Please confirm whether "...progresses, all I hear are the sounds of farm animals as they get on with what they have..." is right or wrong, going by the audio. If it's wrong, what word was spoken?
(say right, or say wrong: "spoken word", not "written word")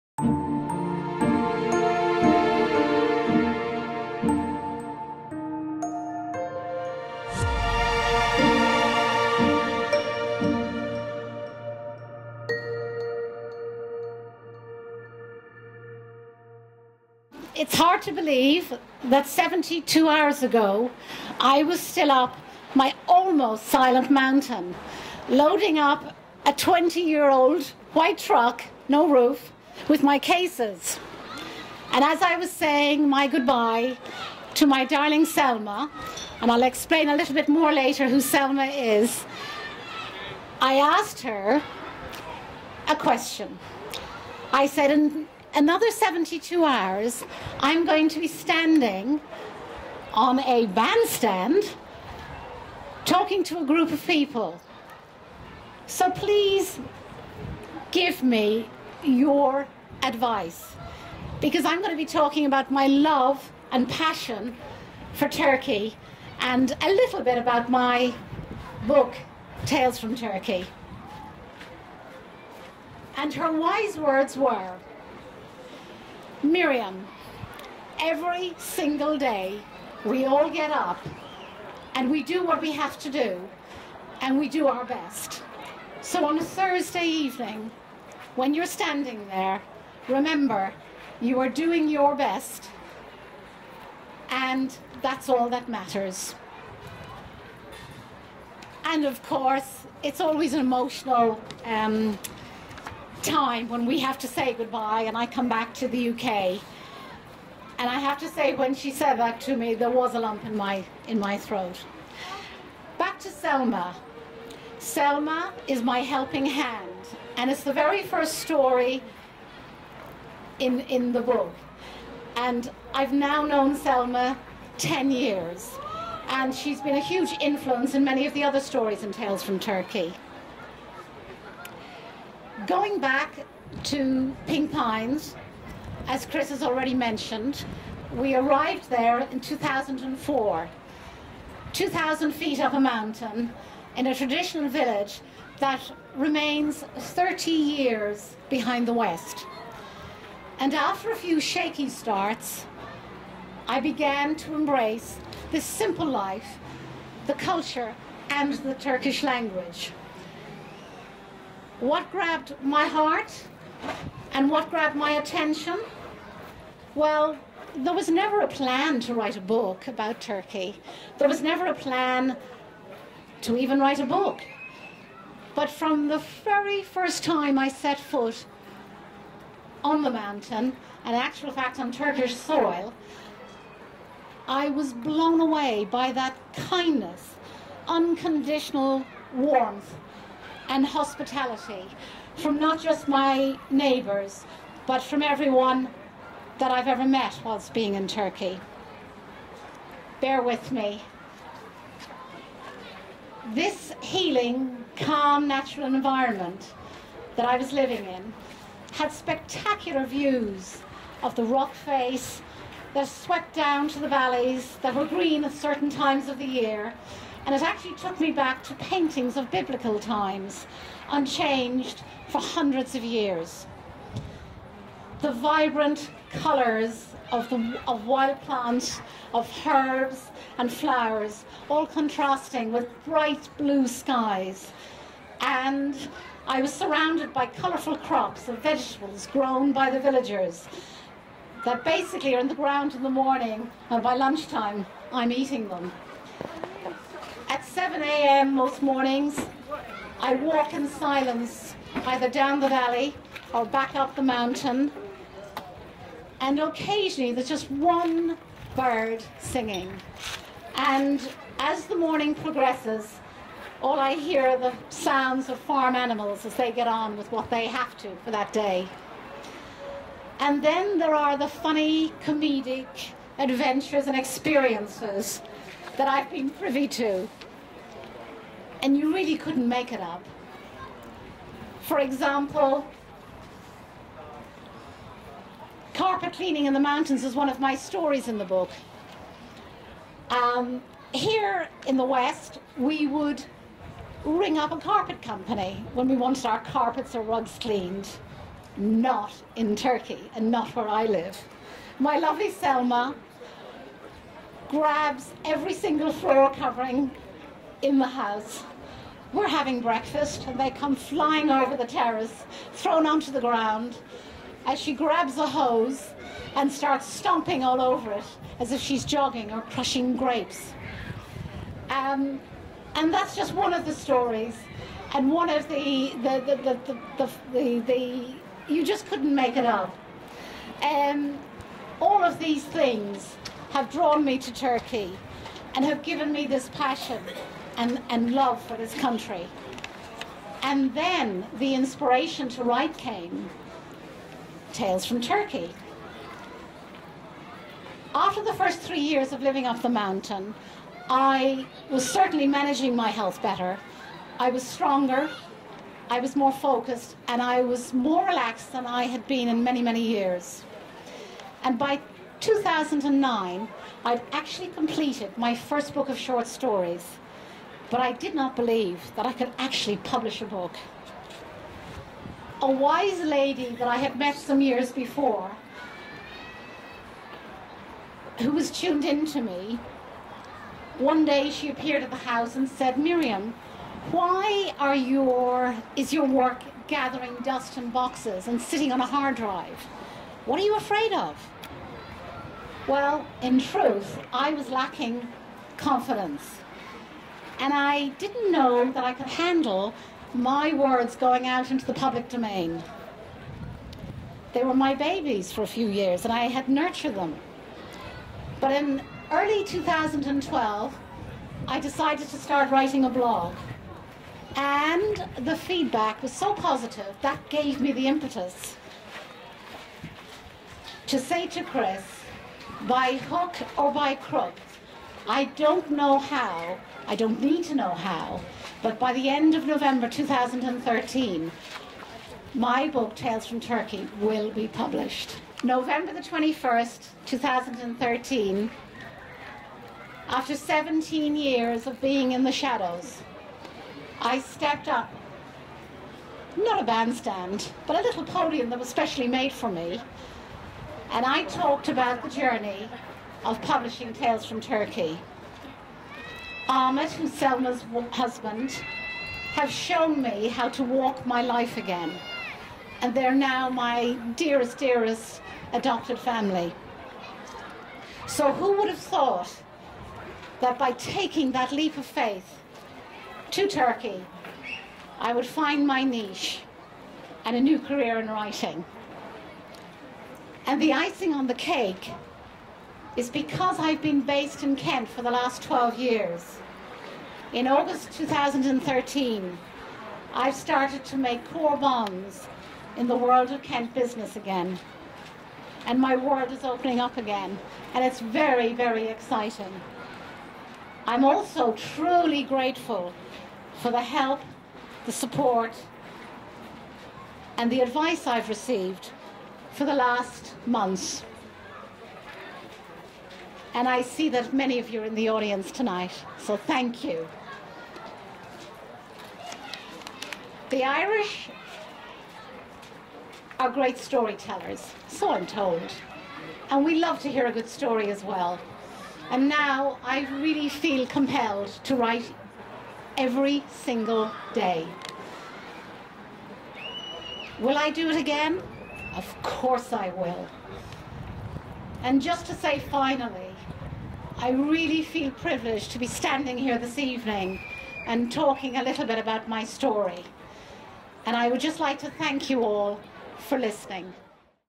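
right.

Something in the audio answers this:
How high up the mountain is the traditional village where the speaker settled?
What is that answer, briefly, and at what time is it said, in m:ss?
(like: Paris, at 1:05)
2,000 feet, at 2:21.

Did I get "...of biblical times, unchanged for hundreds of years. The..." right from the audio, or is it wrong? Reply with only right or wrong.
right.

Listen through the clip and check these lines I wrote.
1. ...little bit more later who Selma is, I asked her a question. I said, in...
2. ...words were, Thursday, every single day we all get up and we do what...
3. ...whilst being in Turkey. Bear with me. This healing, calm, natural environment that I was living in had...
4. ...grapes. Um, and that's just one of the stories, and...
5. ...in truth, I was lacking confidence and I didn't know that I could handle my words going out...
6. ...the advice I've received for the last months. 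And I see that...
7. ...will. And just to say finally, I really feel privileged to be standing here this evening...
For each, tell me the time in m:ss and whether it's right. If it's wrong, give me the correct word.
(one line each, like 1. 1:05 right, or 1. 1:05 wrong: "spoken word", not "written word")
1. 0:37 right
2. 1:13 wrong: "Miriam", not "Thursday"
3. 3:17 right
4. 5:20 right
5. 6:33 right
6. 8:27 right
7. 9:00 right.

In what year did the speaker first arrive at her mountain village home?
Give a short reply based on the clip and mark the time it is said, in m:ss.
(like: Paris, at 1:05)
2004, at 2:19.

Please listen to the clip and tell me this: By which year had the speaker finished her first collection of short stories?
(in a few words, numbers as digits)
2009.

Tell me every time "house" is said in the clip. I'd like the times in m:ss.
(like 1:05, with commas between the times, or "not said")
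5:08, 6:22.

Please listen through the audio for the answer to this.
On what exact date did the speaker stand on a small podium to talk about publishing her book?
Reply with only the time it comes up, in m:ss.
7:15.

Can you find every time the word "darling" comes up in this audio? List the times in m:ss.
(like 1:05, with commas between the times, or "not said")
0:34.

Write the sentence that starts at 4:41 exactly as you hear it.
For example, carpet cleaning in the mountains is one of my stories in the book.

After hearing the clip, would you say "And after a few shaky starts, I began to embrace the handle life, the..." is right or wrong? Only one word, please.
wrong.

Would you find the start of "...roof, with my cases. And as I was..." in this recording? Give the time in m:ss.
0:29.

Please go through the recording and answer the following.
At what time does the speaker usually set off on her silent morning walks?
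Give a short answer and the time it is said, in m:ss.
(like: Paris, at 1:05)
7 a.m., at 4:07.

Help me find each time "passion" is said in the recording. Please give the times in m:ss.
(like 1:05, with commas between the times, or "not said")
1:03, 5:36.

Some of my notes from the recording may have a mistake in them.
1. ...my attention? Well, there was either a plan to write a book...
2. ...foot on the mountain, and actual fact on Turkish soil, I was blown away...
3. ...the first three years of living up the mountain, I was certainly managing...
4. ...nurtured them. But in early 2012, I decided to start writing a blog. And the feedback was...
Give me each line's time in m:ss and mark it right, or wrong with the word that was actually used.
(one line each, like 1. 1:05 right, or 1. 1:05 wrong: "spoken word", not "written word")
1. 2:44 wrong: "never", not "either"
2. 2:57 right
3. 5:48 right
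4. 6:46 right.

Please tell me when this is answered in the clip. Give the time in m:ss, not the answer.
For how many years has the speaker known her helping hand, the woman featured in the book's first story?
2:04.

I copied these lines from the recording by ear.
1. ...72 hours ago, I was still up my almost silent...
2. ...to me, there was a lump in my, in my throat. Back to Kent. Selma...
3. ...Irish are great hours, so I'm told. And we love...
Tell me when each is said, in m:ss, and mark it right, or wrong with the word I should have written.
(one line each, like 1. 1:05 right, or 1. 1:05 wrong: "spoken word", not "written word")
1. 0:19 right
2. 1:49 wrong: "Selma", not "Kent"
3. 8:40 wrong: "storytellers", not "hours".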